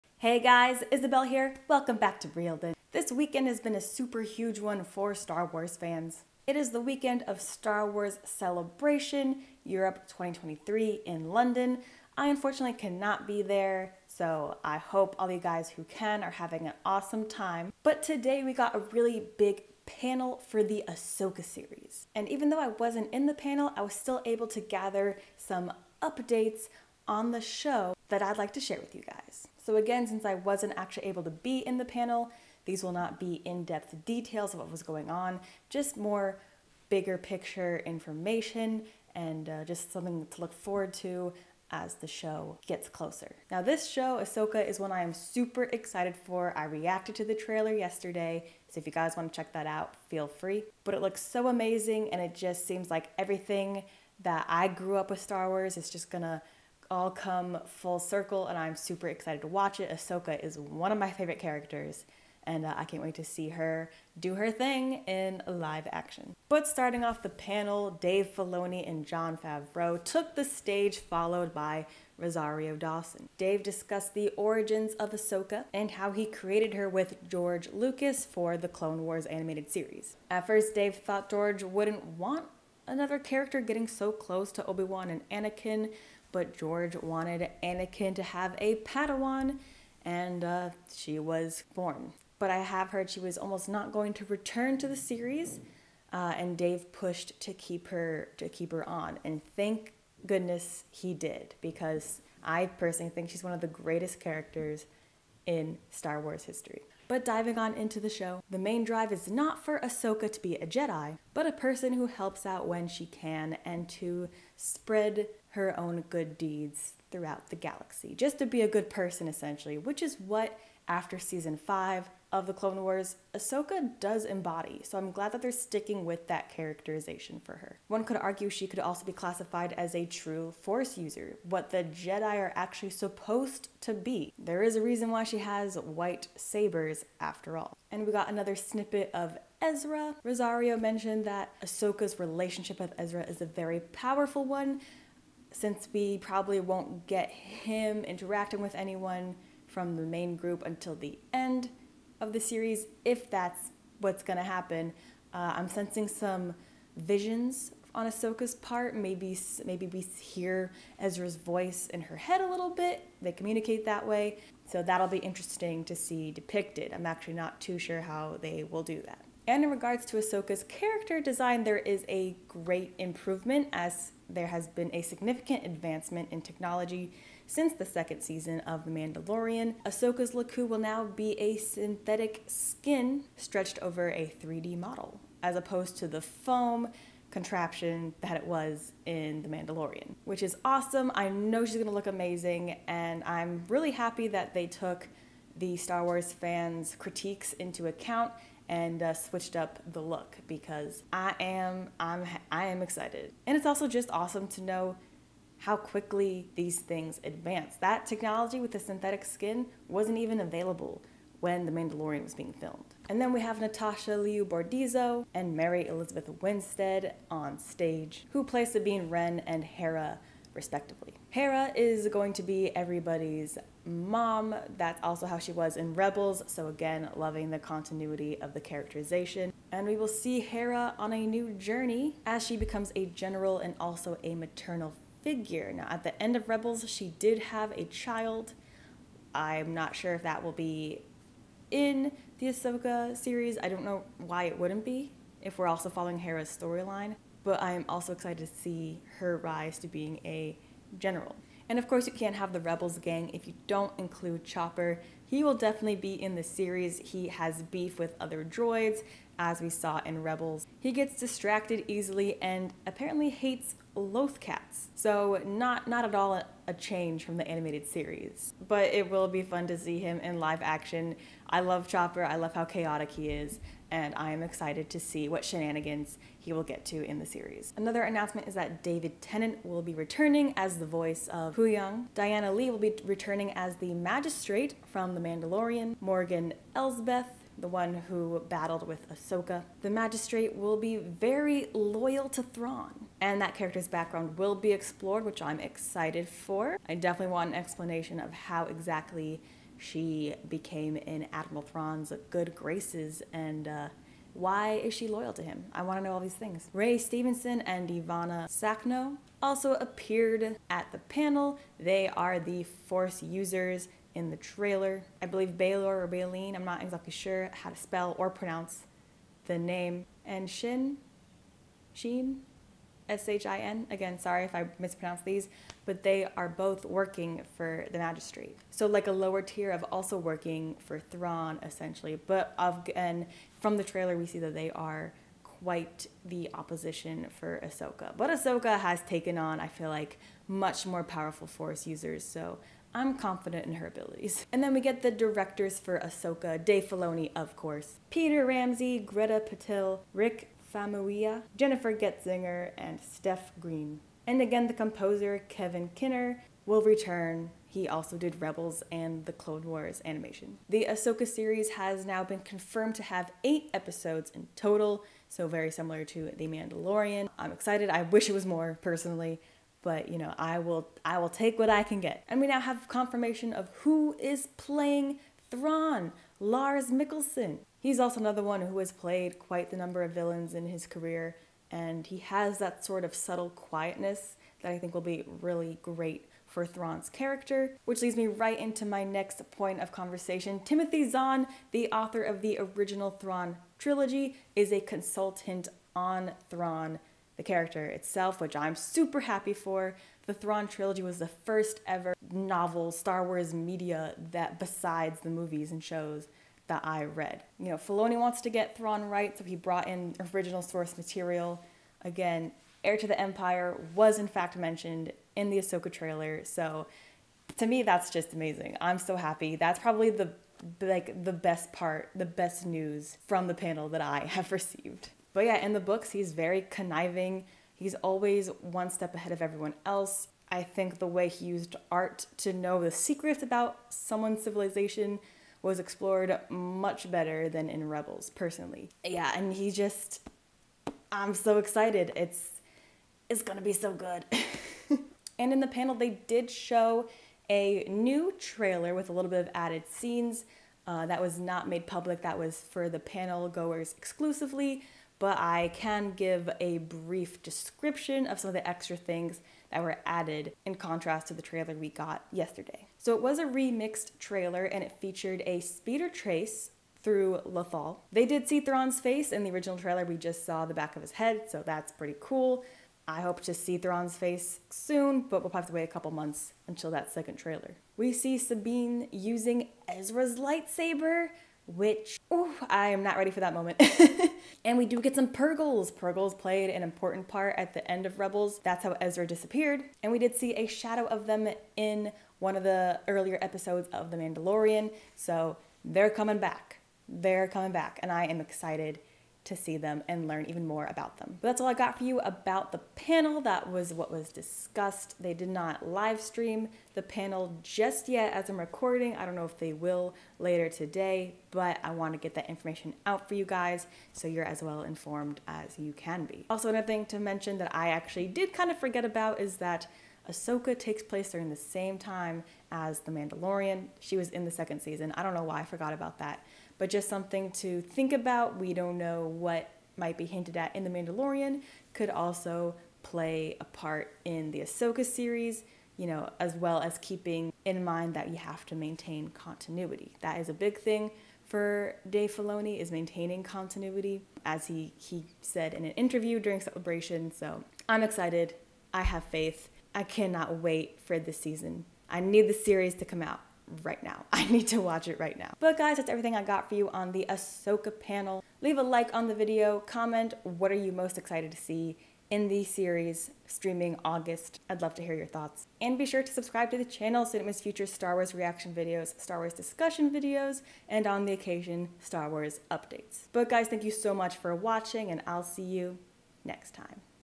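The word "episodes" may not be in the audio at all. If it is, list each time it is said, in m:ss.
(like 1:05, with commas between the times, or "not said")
6:03, 8:13.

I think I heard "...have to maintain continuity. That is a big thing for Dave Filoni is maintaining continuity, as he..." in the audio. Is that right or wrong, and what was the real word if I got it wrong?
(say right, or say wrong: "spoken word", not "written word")
right.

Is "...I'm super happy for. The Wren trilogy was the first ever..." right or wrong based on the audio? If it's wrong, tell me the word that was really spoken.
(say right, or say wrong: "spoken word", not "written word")
wrong: "Thrawn", not "Wren".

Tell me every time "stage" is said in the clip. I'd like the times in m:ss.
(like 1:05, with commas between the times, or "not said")
1:10, 3:37.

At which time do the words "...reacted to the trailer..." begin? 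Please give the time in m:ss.
0:46.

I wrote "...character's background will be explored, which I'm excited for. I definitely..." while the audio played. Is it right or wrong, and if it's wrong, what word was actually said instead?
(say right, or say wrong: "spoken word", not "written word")
right.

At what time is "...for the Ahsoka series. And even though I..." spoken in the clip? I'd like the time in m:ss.
0:20.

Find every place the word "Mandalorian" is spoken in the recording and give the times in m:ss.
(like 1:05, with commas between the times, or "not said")
2:58, 3:09, 3:31, 4:45, 6:06, 8:14, 8:43, 8:50.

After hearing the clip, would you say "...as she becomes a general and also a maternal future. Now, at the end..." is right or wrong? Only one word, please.
wrong.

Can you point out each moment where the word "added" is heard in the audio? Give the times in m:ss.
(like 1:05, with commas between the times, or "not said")
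7:29, 7:40.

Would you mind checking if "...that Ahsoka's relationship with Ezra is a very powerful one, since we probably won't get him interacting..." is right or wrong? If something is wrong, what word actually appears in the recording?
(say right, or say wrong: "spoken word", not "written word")
right.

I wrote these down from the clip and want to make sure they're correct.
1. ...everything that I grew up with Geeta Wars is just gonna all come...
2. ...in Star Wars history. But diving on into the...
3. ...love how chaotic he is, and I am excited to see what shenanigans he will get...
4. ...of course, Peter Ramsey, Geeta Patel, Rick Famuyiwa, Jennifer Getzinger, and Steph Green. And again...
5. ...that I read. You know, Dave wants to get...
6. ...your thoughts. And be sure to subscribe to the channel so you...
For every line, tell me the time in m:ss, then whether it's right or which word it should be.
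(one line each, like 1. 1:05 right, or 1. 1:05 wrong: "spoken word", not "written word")
1. 0:53 wrong: "Star", not "Geeta"
2. 1:45 right
3. 4:32 right
4. 5:47 right
5. 6:46 wrong: "Filoni", not "Dave"
6. 9:25 right.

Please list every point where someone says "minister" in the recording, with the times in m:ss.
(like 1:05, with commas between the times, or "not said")
not said.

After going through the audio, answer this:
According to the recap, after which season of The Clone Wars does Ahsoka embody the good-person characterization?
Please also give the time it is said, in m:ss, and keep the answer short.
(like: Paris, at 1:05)
Season 5, at 2:01.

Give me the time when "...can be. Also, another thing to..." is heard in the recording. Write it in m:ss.
8:35.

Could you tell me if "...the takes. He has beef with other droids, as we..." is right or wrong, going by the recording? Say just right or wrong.
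wrong.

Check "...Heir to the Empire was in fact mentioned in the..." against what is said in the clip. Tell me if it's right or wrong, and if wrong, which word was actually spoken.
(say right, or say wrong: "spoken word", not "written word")
right.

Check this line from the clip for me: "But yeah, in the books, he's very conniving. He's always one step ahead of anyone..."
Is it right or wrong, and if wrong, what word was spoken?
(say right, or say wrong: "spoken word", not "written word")
wrong: "everyone", not "anyone".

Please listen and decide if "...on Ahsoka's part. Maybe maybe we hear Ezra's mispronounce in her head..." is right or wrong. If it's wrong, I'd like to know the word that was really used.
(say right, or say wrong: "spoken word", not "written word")
wrong: "voice", not "mispronounce".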